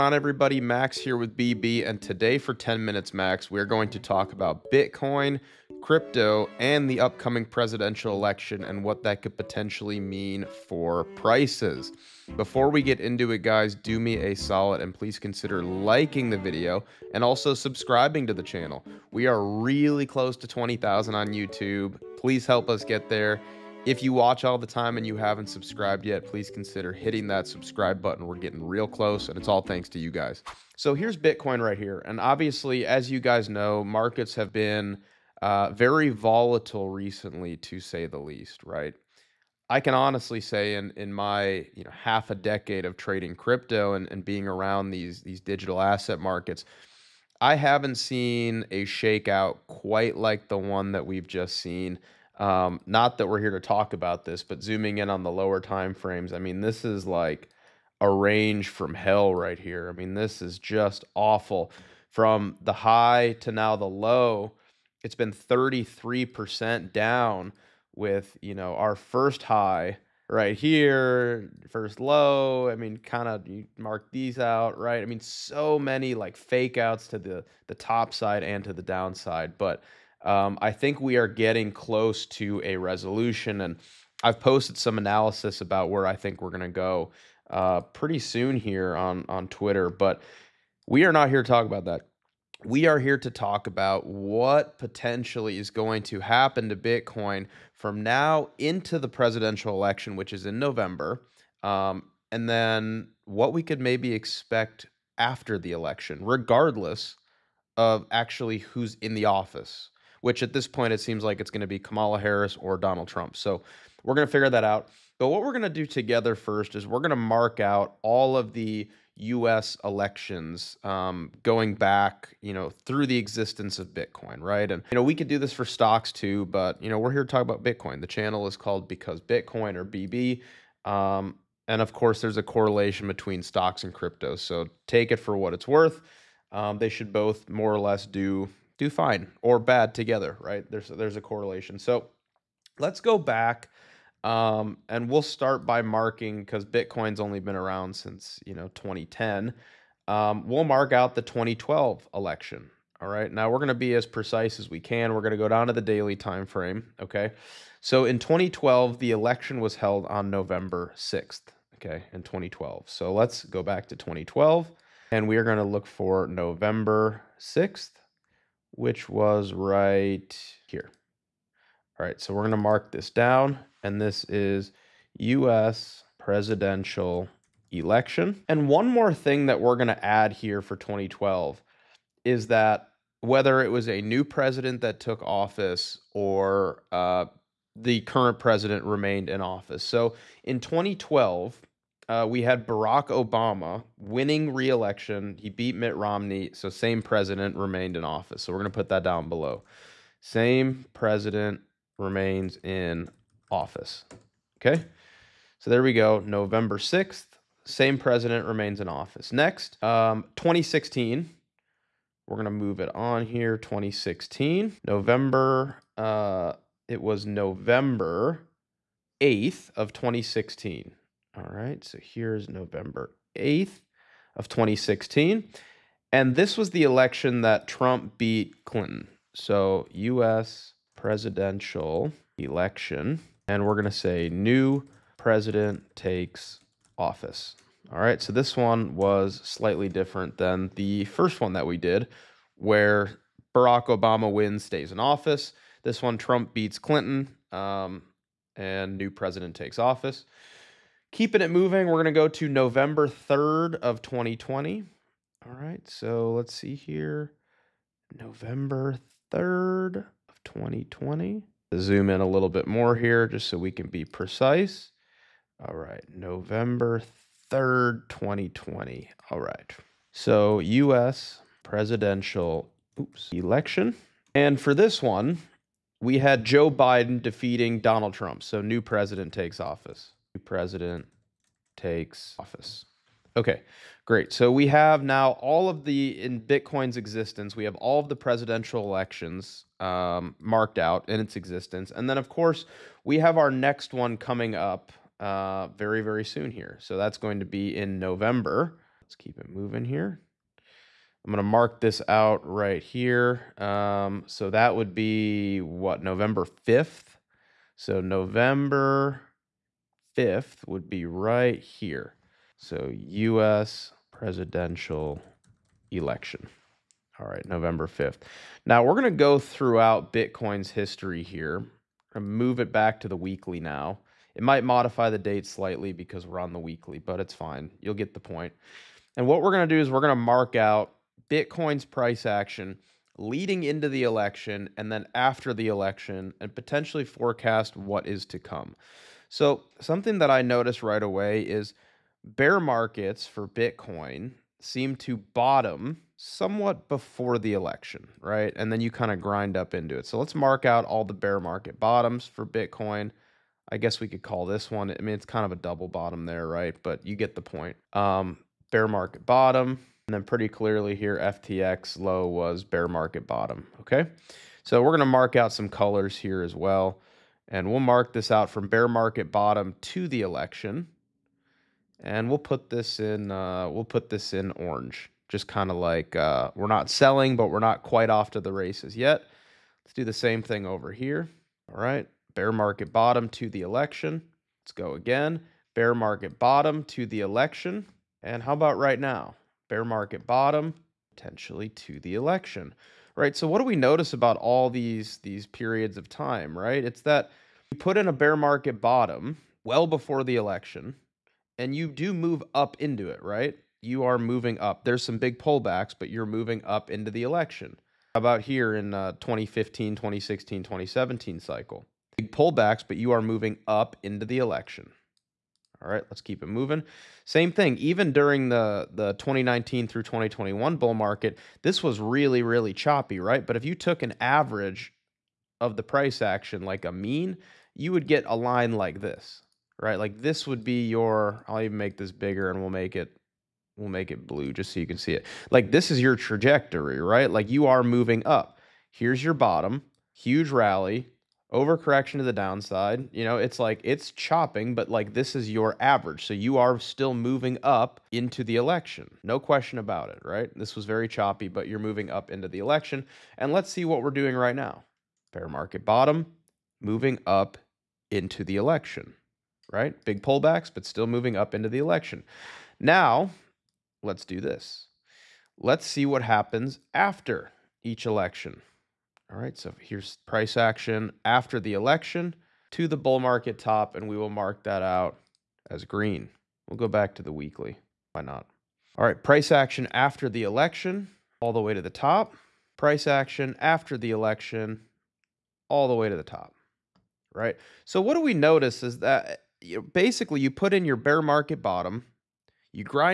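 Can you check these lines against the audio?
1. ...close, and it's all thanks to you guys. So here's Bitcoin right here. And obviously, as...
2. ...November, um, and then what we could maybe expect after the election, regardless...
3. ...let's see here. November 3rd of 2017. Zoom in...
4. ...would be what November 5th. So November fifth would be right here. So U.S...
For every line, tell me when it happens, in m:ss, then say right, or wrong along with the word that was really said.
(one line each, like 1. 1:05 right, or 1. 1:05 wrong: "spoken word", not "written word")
1. 0:28 right
2. 1:40 right
3. 4:16 wrong: "2020", not "2017"
4. 5:04 right.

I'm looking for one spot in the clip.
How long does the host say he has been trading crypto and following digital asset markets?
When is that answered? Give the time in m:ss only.
0:41.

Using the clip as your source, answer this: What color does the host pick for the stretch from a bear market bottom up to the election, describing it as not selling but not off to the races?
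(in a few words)
orange.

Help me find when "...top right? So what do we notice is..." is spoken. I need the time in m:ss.
8:06.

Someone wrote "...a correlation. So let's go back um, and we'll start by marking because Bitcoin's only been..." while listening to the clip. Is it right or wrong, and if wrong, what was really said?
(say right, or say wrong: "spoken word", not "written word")
right.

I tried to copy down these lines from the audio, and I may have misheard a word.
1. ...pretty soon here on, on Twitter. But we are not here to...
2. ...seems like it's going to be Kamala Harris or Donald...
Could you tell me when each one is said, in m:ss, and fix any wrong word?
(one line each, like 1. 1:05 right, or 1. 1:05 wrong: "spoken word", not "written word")
1. 1:27 right
2. 1:50 right.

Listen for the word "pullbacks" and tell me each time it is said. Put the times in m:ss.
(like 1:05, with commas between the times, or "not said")
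6:45, 6:52, 7:40.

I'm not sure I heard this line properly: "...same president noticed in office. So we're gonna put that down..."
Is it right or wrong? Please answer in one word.
wrong.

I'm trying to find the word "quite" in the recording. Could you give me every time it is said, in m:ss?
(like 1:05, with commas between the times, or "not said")
0:49, 6:17.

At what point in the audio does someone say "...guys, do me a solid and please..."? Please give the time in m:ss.
0:13.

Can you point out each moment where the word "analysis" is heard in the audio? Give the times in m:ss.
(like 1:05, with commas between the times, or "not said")
1:24.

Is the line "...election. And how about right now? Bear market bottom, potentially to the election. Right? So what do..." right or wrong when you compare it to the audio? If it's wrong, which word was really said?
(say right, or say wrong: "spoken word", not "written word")
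right.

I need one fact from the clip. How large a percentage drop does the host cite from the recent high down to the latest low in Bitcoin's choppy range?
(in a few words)
33%.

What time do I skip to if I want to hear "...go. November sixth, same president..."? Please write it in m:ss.
3:25.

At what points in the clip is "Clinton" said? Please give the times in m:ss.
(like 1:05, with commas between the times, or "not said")
3:48, 4:06.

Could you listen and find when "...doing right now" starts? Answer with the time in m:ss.
7:34.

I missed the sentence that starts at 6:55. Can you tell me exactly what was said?
All right, let's keep it moving.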